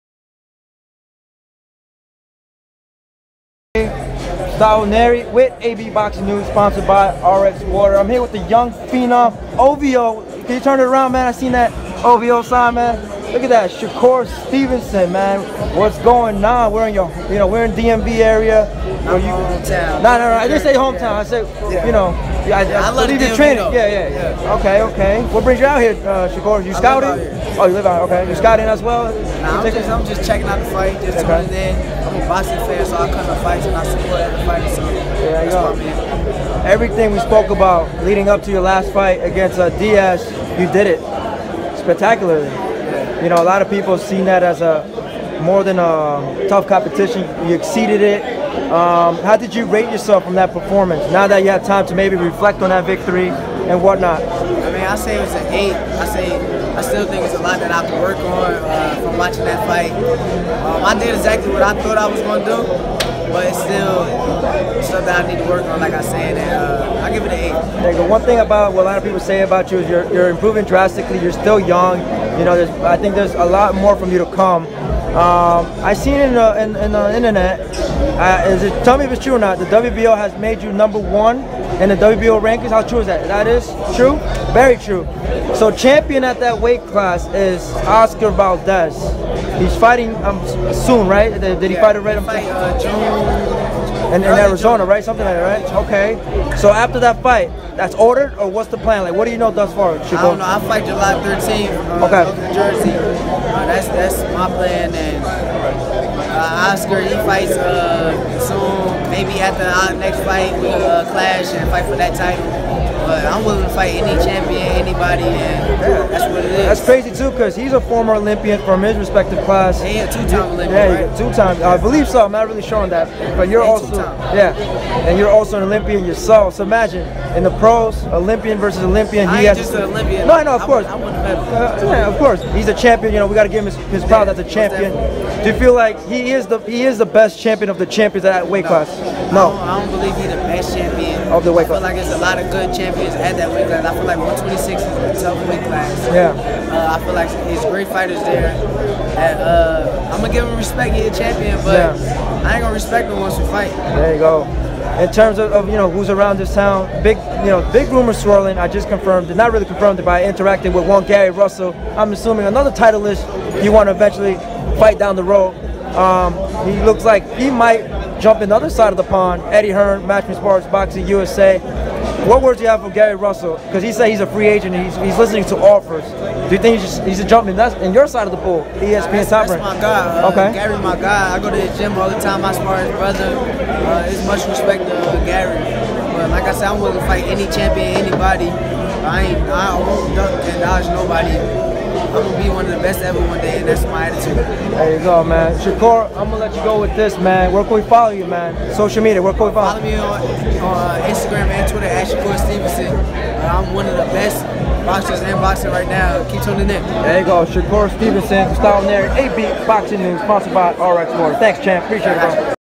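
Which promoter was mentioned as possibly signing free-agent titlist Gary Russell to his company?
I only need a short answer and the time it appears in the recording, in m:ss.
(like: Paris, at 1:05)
Eddie Hearn, at 2:49.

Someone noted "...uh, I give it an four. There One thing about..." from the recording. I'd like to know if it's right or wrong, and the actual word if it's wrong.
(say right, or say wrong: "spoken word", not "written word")
wrong: "eight", not "four".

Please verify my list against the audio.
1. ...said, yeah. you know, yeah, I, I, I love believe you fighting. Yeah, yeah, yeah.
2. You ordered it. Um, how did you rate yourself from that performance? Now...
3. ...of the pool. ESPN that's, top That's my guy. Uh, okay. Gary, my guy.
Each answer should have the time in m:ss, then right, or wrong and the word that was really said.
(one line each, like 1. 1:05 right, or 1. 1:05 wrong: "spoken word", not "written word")
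1. 0:21 wrong: "training", not "fighting"
2. 0:47 wrong: "exceeded", not "ordered"
3. 2:58 right.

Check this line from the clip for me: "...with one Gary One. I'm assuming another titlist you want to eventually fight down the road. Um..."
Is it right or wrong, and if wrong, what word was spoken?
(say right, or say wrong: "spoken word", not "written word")
wrong: "Russell", not "One".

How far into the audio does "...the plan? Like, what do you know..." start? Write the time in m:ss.
1:38.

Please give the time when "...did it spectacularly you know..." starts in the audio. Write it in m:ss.
0:40.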